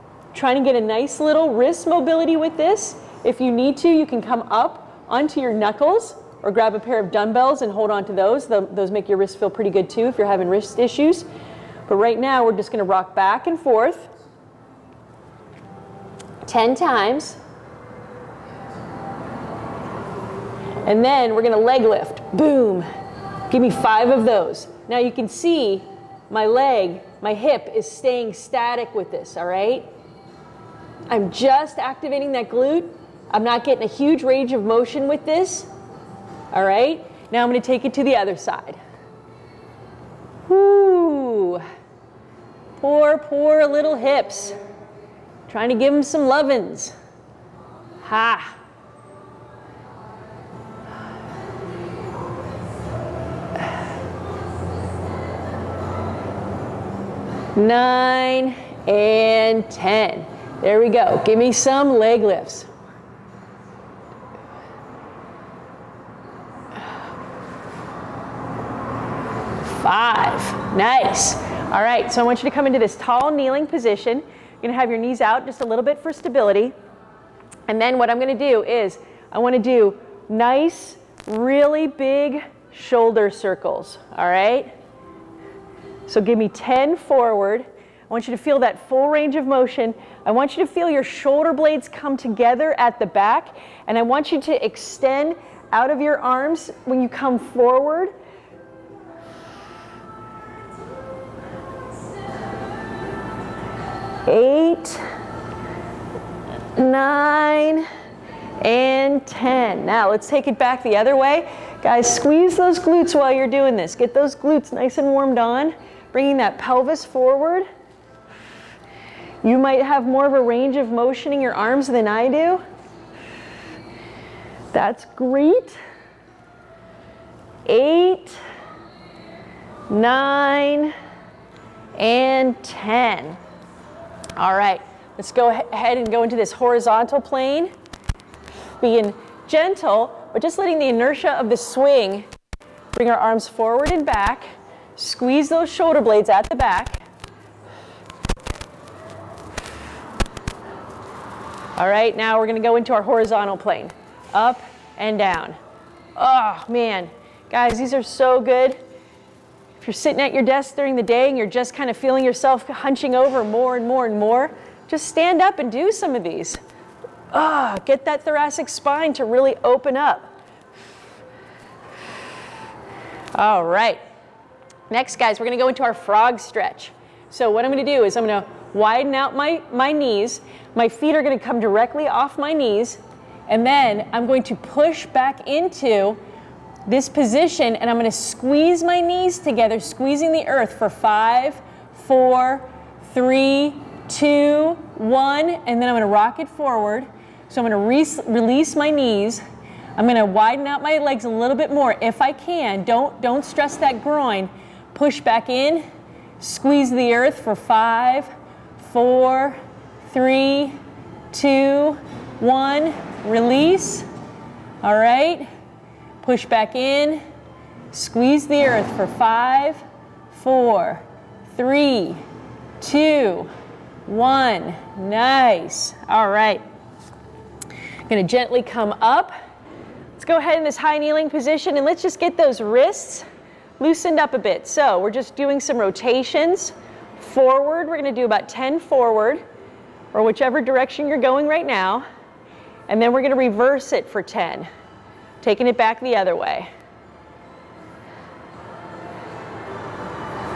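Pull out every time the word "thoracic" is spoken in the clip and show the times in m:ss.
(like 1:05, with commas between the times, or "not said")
2:48.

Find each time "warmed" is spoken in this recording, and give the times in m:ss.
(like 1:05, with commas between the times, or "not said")
1:55.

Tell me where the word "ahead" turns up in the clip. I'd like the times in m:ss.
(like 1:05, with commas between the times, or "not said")
2:15, 3:50.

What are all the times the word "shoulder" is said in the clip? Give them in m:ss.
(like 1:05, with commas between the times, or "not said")
1:22, 1:31, 2:25.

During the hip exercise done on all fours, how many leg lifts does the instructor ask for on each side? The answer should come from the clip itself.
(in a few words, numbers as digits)
5.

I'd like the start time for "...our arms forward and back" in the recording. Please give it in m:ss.
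2:23.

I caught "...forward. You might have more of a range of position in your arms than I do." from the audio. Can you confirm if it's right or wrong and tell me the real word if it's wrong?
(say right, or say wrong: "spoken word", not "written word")
wrong: "motion", not "position".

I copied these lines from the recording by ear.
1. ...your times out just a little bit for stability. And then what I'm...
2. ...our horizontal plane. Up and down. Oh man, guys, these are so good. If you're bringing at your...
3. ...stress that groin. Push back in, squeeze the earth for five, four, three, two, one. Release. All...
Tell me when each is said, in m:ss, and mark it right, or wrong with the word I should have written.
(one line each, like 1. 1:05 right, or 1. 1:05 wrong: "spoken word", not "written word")
1. 1:14 wrong: "knees", not "times"
2. 2:32 wrong: "sitting", not "bringing"
3. 3:23 right.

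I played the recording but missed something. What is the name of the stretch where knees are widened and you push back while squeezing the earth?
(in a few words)
Frog stretch.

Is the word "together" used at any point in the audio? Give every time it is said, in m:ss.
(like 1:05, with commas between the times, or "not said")
1:32, 3:09.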